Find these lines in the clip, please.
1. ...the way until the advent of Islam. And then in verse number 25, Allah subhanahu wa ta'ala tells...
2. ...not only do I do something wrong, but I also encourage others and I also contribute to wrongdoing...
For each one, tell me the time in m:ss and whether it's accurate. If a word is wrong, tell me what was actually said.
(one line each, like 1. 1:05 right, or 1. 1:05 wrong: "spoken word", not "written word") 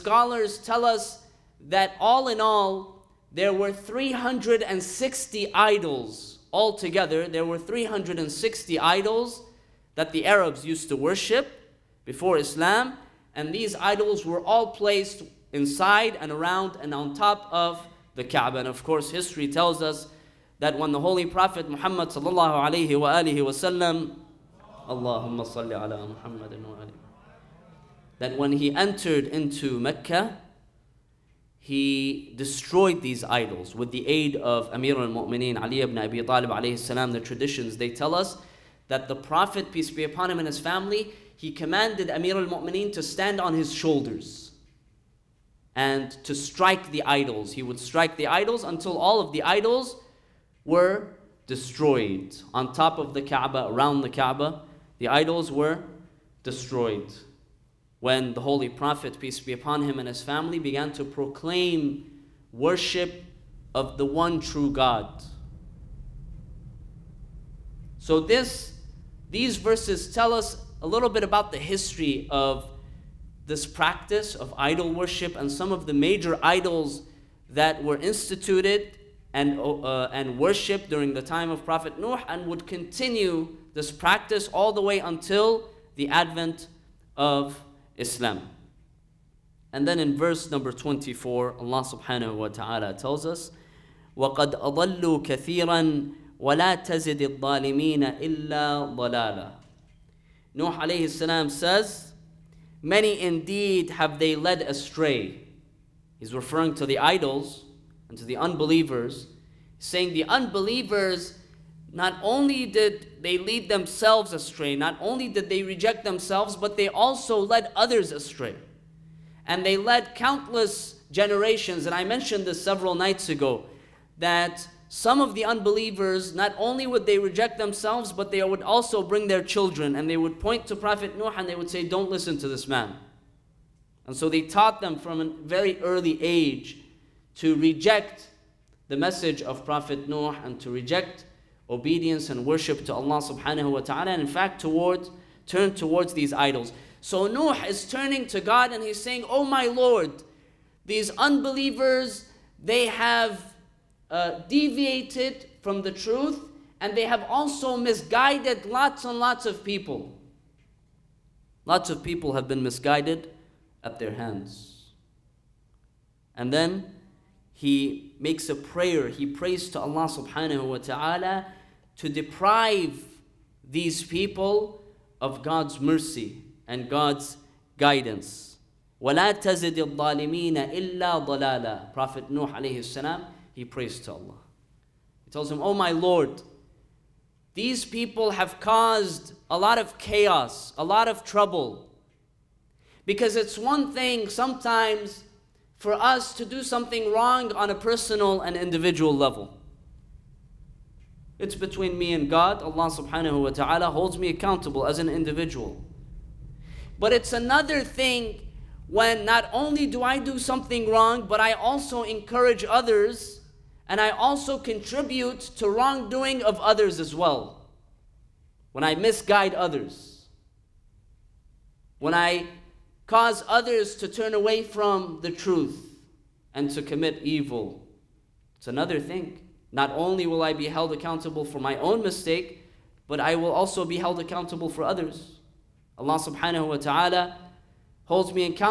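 1. 1:24 wrong: "24", not "25"
2. 3:29 right.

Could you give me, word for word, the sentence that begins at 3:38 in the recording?
When I misguide others, when I cause others to turn away from the truth and to commit evil.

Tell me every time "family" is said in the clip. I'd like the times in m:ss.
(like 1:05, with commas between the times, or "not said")
0:40, 1:00.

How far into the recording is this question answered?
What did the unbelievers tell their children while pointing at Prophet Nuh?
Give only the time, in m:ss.
2:11.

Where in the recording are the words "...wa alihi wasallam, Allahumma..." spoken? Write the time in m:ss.
0:22.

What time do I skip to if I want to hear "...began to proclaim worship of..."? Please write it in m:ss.
1:00.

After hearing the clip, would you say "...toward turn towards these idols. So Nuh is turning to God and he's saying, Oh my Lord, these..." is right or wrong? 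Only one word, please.
right.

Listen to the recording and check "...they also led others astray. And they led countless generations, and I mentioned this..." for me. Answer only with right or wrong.
right.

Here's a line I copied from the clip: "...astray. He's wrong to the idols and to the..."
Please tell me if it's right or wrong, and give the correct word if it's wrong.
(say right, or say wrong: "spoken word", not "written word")
wrong: "referring", not "wrong".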